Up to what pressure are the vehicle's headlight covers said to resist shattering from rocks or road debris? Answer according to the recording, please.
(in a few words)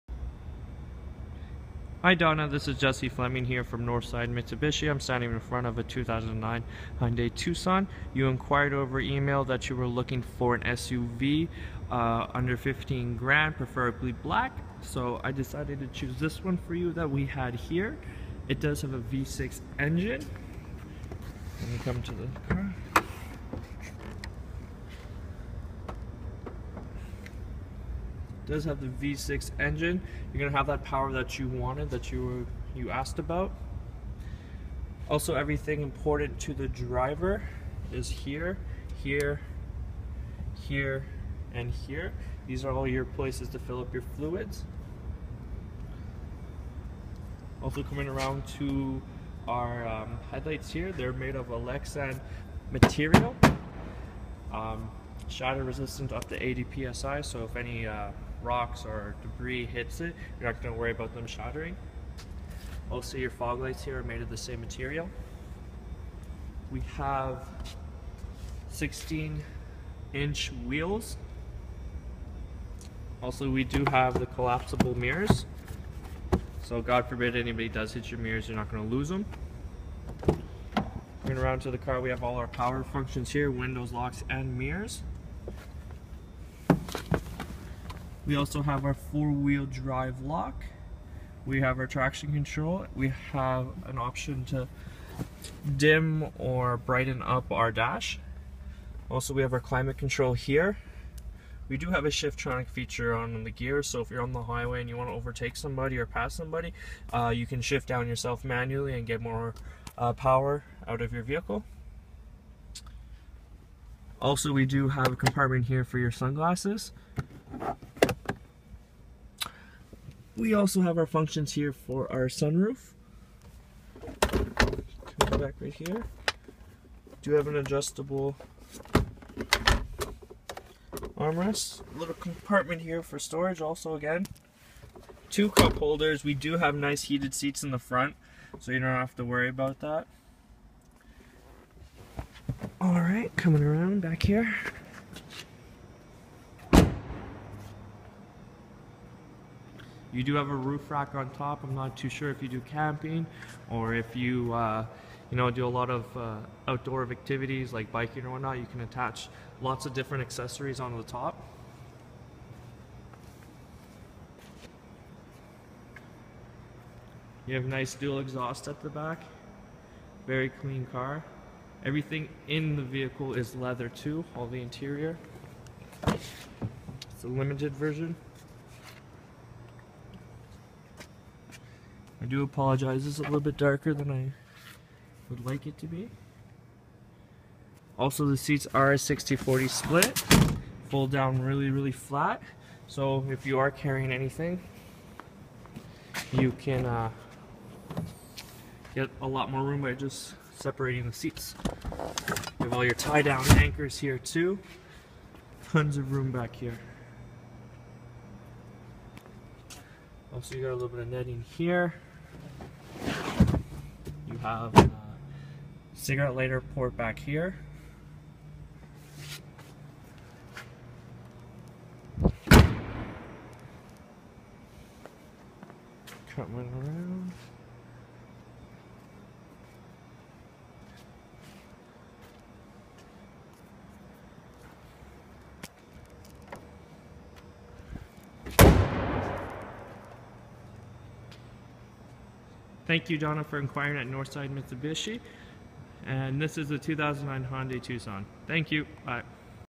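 80 psi.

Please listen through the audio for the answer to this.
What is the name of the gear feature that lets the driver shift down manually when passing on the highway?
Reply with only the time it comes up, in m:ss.
1:42.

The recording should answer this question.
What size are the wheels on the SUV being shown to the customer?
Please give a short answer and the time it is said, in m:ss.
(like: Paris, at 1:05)
16 inch, at 1:08.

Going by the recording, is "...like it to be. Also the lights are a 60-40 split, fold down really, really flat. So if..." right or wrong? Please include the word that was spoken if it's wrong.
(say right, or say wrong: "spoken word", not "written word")
wrong: "seats", not "lights".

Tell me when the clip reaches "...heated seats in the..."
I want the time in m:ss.
2:17.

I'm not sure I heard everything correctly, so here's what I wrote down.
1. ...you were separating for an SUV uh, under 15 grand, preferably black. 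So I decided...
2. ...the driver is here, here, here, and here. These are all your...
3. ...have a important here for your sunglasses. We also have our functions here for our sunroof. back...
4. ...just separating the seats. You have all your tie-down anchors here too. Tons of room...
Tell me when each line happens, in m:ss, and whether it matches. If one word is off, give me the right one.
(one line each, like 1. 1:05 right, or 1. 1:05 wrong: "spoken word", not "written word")
1. 0:09 wrong: "looking", not "separating"
2. 0:36 right
3. 1:54 wrong: "compartment", not "important"
4. 3:19 right.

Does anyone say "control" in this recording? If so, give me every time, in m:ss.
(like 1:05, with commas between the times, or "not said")
1:32, 1:39.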